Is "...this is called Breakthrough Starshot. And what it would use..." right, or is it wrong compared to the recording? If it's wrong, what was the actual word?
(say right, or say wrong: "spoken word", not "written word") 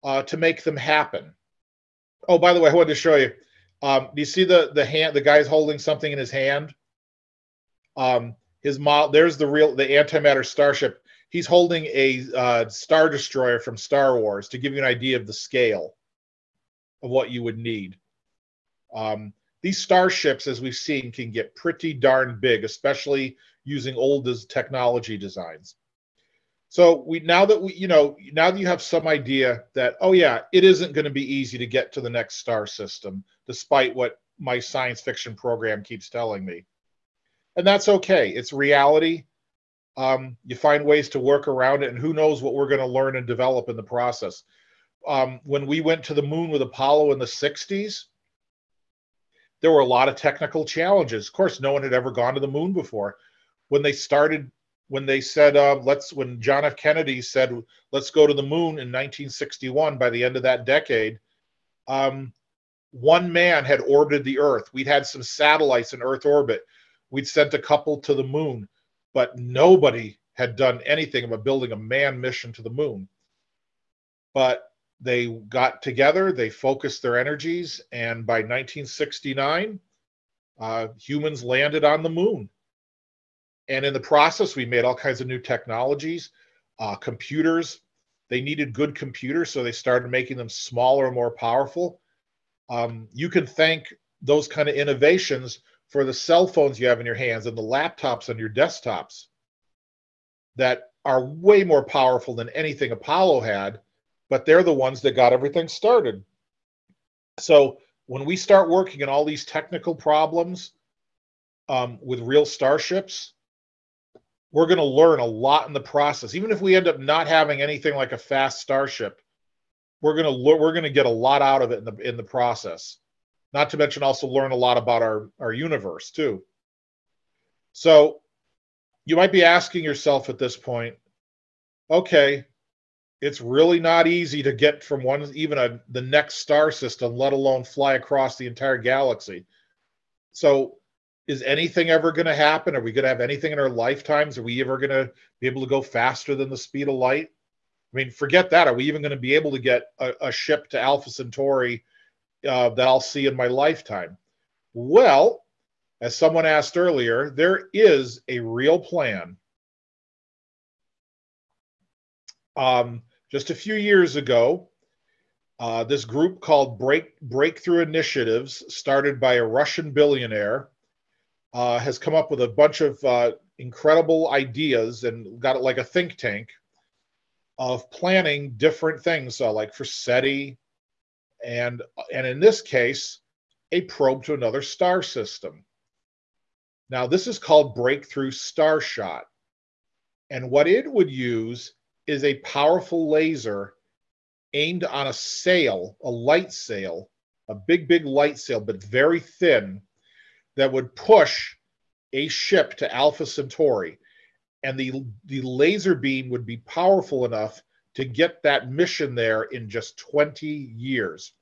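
right.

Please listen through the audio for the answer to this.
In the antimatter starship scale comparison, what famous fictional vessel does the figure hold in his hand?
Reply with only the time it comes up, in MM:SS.
00:12.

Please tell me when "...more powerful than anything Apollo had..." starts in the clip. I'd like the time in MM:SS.
01:41.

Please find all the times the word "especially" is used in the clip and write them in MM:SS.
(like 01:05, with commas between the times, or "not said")
00:22.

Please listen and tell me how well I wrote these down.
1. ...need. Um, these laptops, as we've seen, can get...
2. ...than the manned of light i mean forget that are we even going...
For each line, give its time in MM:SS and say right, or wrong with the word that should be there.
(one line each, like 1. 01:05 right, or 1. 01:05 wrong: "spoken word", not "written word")
1. 00:17 wrong: "starships", not "laptops"
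2. 02:26 wrong: "speed", not "manned".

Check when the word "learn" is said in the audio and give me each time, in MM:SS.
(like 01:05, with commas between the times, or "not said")
00:42, 01:54, 02:04.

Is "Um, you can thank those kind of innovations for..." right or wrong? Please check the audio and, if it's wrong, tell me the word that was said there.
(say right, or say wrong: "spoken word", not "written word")
right.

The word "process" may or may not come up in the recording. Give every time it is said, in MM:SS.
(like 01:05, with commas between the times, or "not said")
00:43, 01:23, 01:55, 02:02.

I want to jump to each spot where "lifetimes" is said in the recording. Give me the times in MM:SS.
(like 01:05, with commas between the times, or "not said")
02:23, 02:33.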